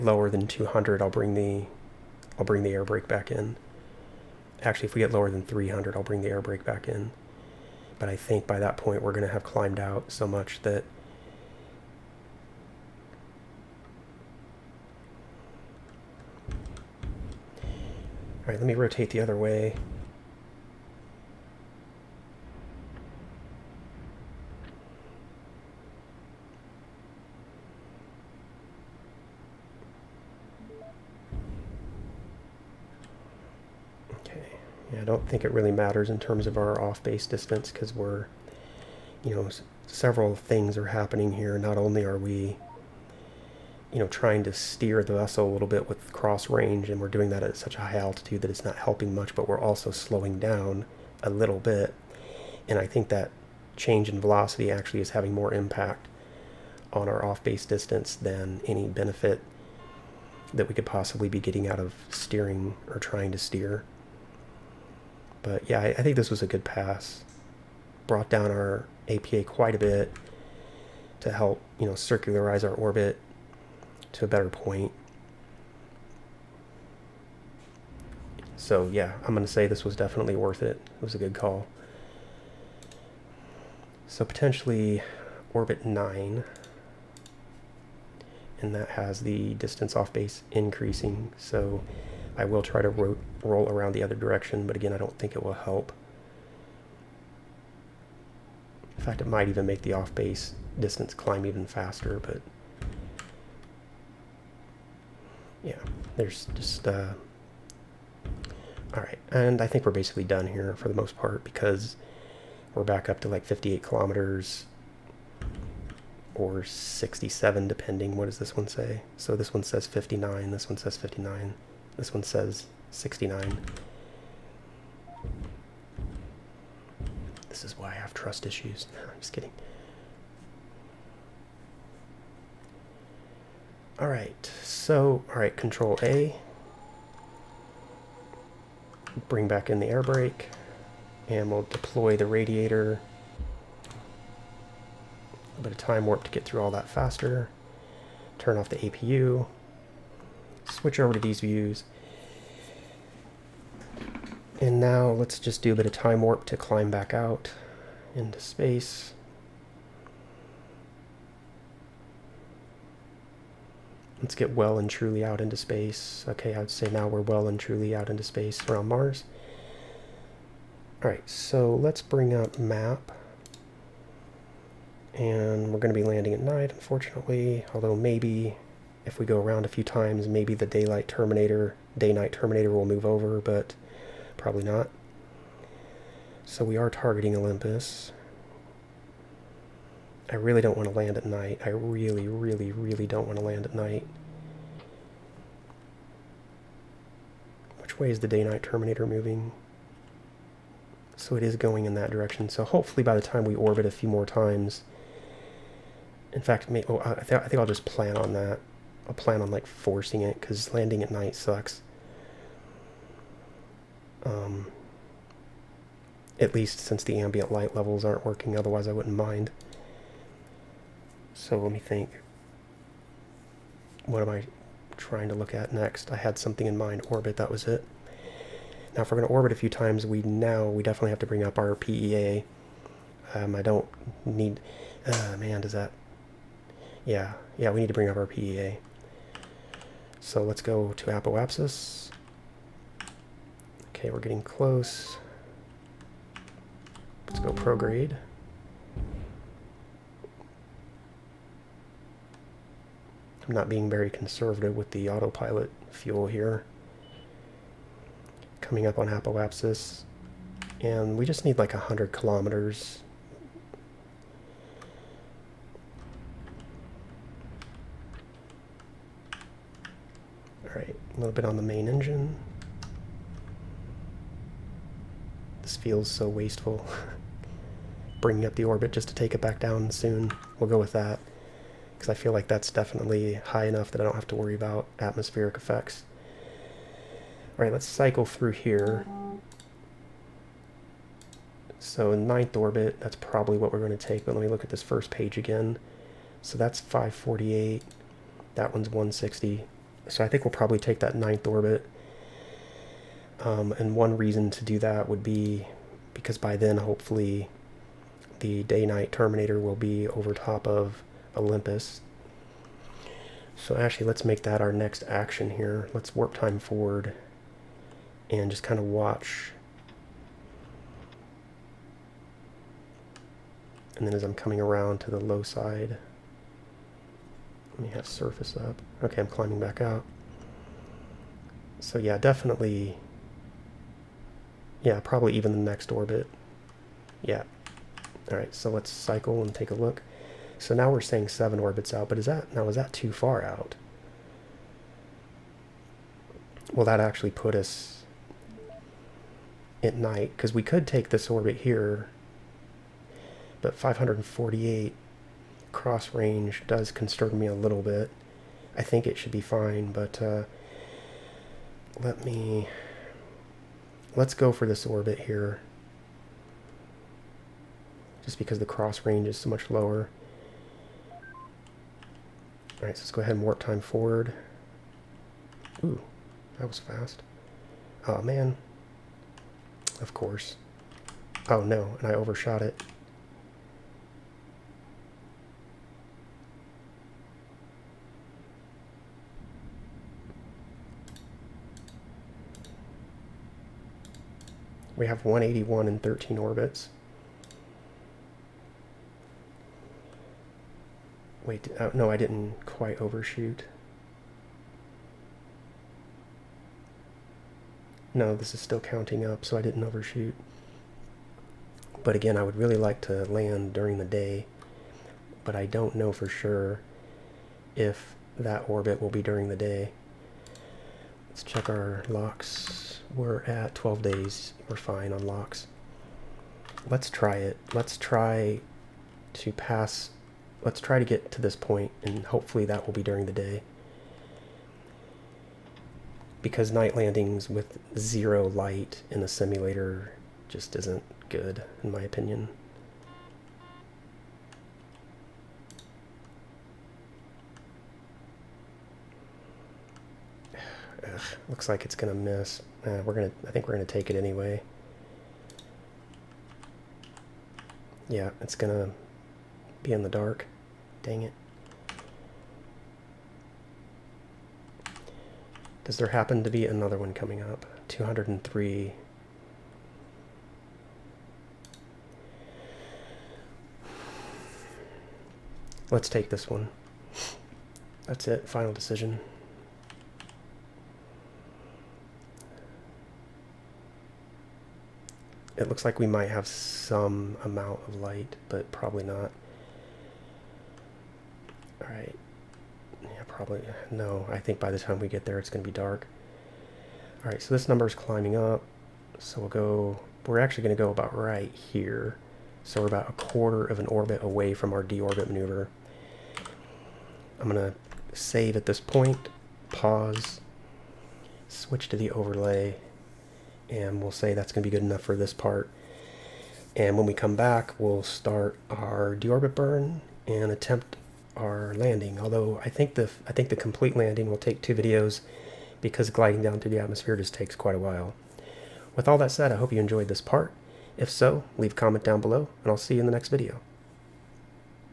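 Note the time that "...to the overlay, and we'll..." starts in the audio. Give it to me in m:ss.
8:31.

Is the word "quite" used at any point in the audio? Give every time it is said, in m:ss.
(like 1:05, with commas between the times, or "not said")
1:09, 6:42, 8:47.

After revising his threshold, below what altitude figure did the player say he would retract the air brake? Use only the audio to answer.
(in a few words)
300.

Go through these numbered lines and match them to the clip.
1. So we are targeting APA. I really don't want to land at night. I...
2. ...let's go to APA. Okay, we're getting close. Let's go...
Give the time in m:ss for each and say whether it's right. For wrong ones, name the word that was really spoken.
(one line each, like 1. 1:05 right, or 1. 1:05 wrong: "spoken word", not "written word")
1. 3:06 wrong: "Olympus", not "APA"
2. 4:00 wrong: "Apoapsis", not "APA".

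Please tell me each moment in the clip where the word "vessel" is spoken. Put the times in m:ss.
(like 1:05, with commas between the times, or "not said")
0:45.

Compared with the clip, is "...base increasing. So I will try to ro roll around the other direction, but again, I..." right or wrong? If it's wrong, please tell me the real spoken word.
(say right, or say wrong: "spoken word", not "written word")
right.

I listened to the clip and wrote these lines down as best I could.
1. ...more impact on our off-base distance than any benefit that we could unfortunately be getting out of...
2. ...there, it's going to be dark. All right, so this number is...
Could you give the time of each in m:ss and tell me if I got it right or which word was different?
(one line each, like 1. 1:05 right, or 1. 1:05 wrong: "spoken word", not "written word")
1. 0:55 wrong: "possibly", not "unfortunately"
2. 8:15 right.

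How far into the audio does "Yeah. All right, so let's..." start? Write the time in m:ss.
5:37.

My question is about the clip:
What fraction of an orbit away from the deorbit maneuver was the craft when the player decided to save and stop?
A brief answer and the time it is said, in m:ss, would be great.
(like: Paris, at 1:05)
a quarter, at 8:23.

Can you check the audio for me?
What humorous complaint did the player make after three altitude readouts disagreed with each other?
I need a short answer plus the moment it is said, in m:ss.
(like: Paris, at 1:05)
trust issues, at 2:08.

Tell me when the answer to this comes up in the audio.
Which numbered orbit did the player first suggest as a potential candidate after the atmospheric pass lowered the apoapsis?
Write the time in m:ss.
1:25.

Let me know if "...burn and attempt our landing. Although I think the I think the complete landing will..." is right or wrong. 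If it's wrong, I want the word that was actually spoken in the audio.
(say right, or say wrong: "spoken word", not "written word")
right.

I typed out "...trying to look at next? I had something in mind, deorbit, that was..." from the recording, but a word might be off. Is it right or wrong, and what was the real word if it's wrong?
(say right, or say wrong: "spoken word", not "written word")
wrong: "orbit", not "deorbit".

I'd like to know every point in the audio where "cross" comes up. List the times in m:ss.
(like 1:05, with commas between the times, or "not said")
0:46, 5:55, 6:08.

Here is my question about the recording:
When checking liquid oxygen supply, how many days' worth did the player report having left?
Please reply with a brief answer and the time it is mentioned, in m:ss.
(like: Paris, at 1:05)
12 days, at 7:03.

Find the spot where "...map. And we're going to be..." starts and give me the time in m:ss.
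2:52.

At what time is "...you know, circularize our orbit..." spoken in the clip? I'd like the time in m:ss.
1:11.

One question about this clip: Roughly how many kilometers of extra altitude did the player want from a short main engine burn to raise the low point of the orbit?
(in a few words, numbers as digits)
100 kilometers.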